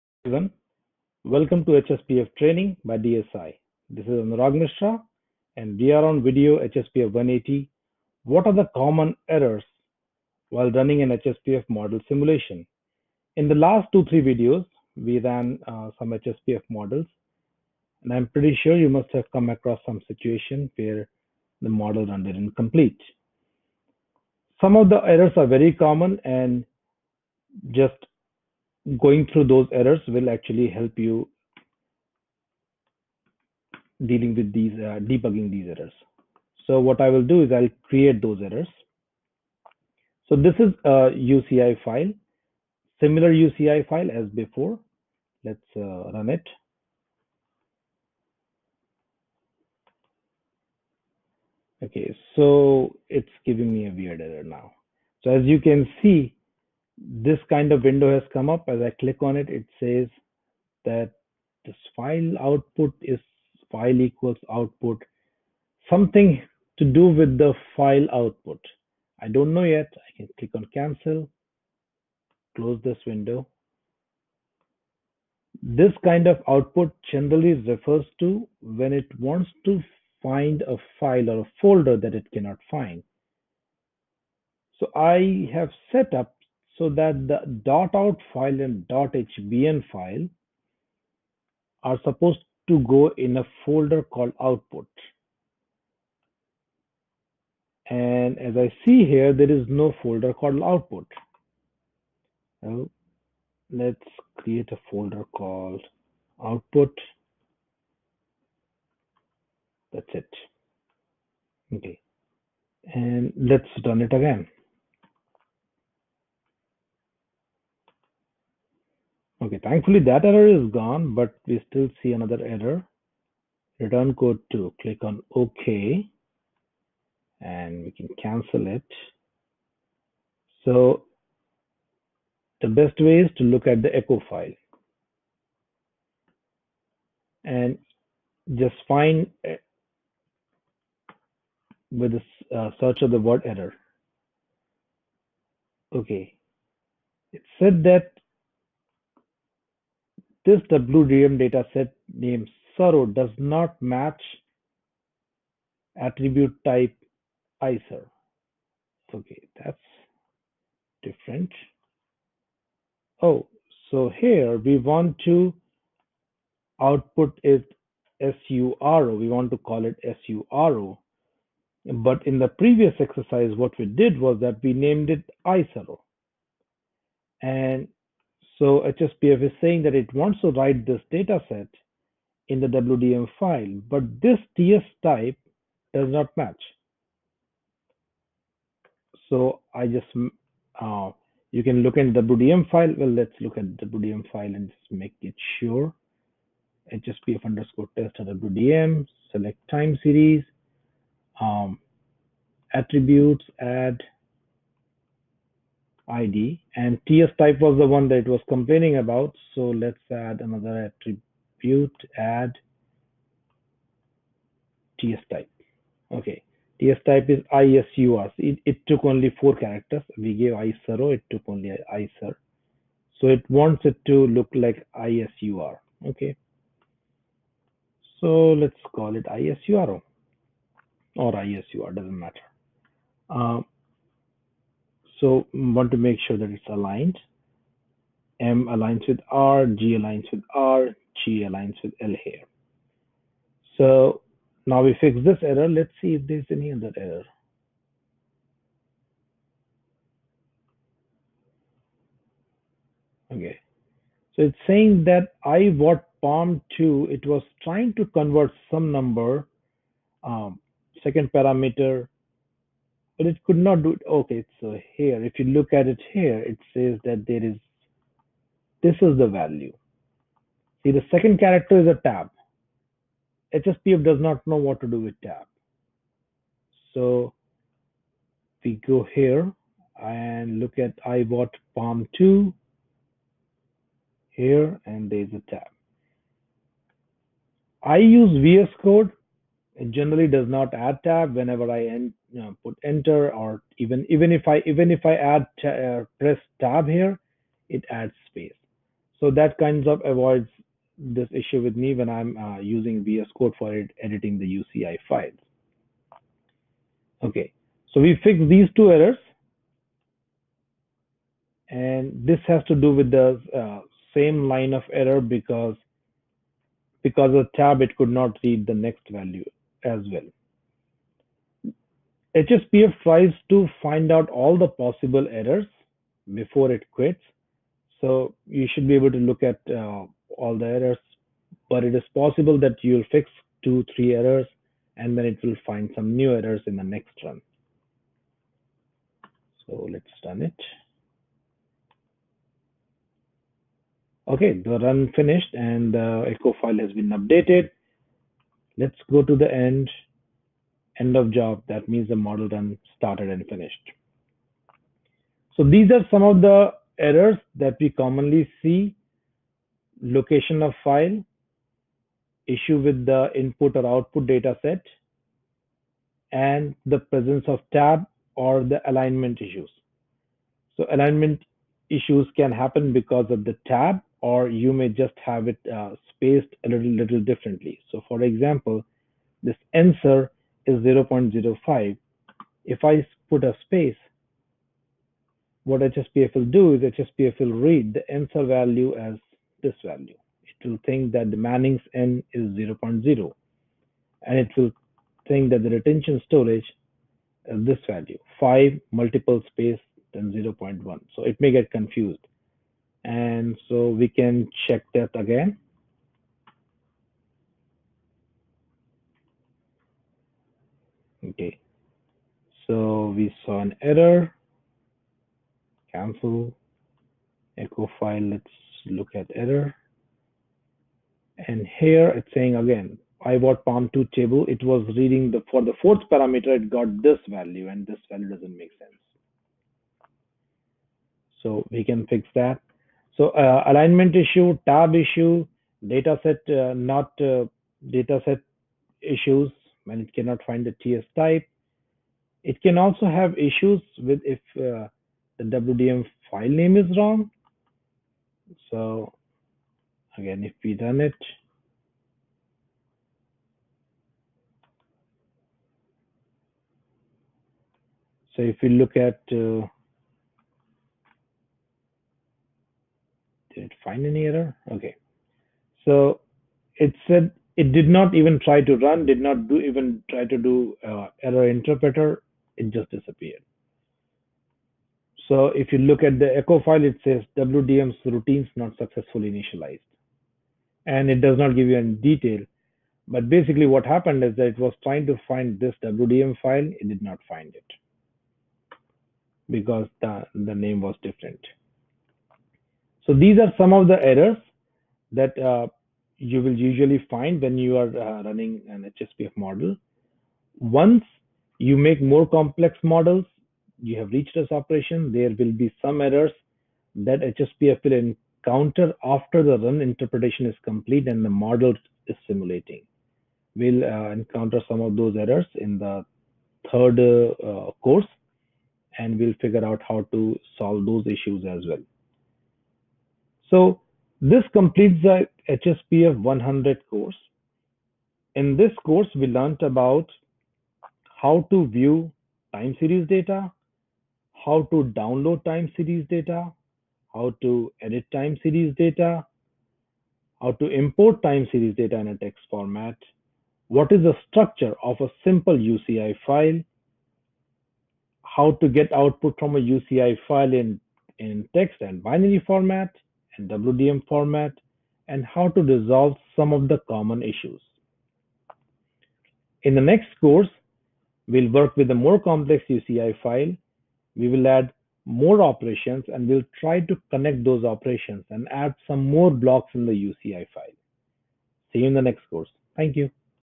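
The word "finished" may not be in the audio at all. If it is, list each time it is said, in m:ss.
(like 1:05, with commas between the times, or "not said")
5:45, 5:53.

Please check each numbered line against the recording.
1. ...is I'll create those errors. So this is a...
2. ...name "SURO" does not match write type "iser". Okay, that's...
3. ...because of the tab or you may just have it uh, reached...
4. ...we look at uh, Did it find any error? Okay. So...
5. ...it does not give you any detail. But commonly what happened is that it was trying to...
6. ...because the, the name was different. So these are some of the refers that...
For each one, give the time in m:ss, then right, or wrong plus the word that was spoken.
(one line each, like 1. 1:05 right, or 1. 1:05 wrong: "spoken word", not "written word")
1. 0:37 right
2. 2:32 wrong: "attribute", not "write"
3. 6:12 wrong: "spaced", not "reached"
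4. 7:38 right
5. 8:01 wrong: "basically", not "commonly"
6. 8:09 wrong: "errors", not "refers".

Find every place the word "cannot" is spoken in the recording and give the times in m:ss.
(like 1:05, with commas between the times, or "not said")
1:22, 7:20.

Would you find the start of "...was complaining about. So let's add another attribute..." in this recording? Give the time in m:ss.
3:28.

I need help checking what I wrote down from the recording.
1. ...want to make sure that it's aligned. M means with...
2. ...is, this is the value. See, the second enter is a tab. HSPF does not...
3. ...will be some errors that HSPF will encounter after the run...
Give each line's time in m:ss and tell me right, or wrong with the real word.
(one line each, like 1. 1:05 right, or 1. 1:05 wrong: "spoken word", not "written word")
1. 3:55 wrong: "aligns", not "means"
2. 4:27 wrong: "character", not "enter"
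3. 8:25 right.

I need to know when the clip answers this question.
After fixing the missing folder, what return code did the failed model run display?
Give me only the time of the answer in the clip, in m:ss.
2:03.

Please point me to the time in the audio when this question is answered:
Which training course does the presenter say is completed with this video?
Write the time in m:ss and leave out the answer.
8:44.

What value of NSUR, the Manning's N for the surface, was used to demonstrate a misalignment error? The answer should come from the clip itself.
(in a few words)
0.05.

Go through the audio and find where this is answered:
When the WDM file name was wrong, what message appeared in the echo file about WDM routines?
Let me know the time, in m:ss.
7:57.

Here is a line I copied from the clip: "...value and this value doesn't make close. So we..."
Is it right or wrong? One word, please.
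wrong.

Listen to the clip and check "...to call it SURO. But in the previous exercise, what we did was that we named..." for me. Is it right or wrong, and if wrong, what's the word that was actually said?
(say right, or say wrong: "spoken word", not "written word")
right.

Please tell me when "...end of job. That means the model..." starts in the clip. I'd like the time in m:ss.
5:50.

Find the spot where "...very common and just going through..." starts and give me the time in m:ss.
0:25.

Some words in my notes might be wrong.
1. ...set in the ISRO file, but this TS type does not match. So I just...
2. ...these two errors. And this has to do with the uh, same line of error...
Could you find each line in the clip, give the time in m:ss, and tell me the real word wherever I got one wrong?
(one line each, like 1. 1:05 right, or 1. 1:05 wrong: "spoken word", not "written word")
1. 3:01 wrong: "WDM", not "ISRO"
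2. 5:08 right.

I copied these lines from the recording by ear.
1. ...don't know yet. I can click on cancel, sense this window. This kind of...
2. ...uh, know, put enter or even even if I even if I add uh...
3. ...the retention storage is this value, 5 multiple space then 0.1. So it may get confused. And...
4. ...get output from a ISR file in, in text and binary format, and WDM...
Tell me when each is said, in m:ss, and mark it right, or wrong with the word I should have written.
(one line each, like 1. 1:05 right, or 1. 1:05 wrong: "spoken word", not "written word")
1. 1:09 wrong: "close", not "sense"
2. 4:52 right
3. 6:35 right
4. 9:08 wrong: "UCI", not "ISR".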